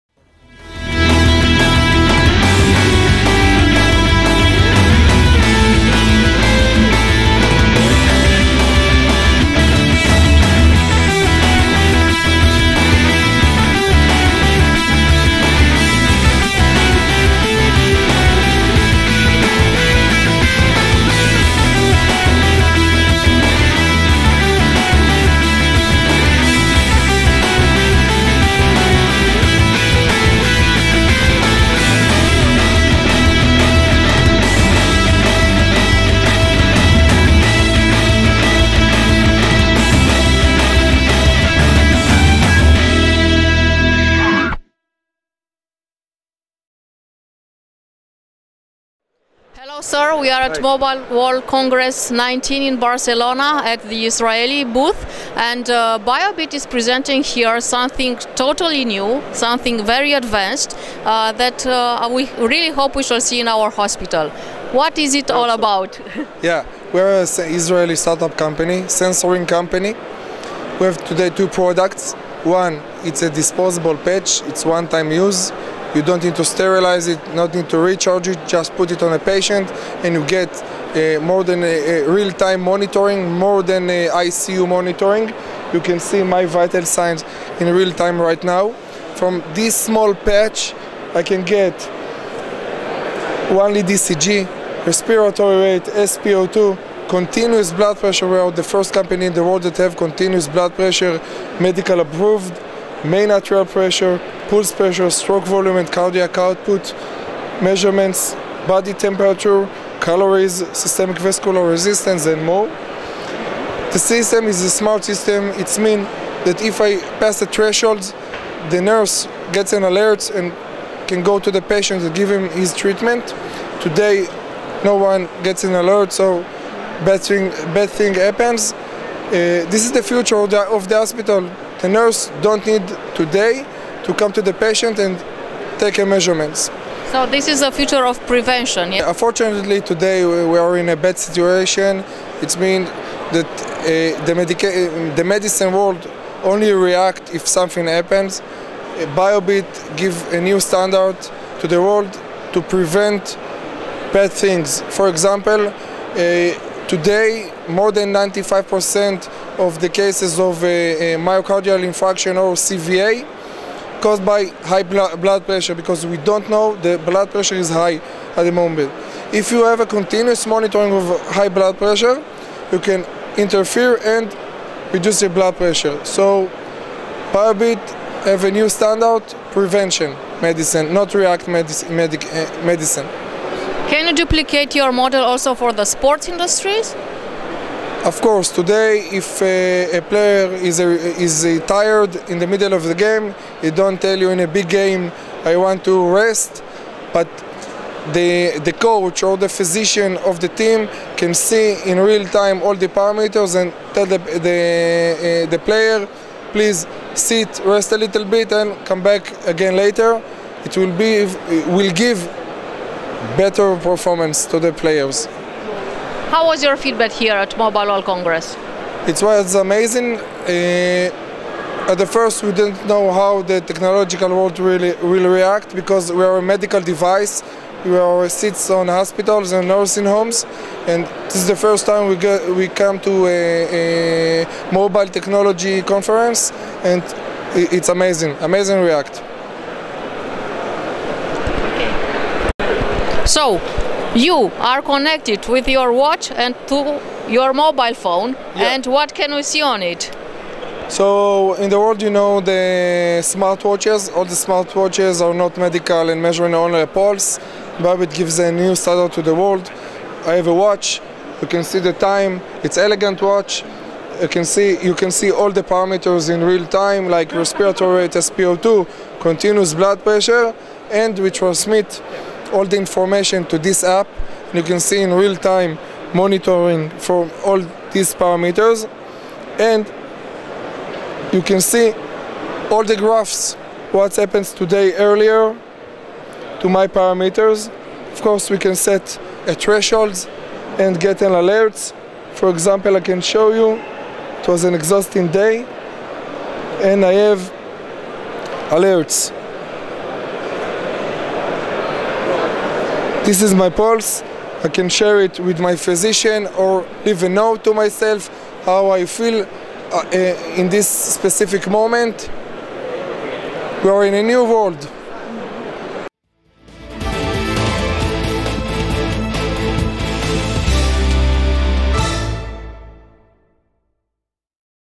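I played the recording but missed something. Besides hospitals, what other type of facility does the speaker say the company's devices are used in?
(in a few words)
Nursing homes.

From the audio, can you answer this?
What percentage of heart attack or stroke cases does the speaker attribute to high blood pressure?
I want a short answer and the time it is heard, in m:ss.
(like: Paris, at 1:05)
95%, at 2:38.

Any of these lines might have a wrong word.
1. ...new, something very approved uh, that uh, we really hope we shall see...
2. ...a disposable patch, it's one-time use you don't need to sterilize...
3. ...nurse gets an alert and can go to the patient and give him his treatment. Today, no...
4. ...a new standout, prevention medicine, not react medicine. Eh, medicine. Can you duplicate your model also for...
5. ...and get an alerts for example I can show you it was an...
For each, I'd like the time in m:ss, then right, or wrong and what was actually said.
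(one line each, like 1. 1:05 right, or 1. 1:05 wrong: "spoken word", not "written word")
1. 0:58 wrong: "advanced", not "approved"
2. 1:13 right
3. 1:58 right
4. 2:58 right
5. 4:50 right.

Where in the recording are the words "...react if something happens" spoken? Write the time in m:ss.
2:26.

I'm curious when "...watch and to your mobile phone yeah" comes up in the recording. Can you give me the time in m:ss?
4:05.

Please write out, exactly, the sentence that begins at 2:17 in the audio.
So this is the future of prevention.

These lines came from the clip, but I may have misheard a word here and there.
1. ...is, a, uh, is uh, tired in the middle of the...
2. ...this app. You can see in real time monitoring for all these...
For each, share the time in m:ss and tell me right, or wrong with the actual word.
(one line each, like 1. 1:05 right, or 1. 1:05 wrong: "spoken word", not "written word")
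1. 3:10 right
2. 4:33 right.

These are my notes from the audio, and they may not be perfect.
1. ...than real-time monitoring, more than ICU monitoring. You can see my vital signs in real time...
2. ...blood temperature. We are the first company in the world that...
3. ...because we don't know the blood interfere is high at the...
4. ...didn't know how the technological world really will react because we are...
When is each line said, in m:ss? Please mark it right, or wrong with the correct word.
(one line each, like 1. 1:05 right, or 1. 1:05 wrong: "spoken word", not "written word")
1. 1:21 right
2. 1:37 wrong: "pressure", not "temperature"
3. 2:45 wrong: "pressure", not "interfere"
4. 3:42 right.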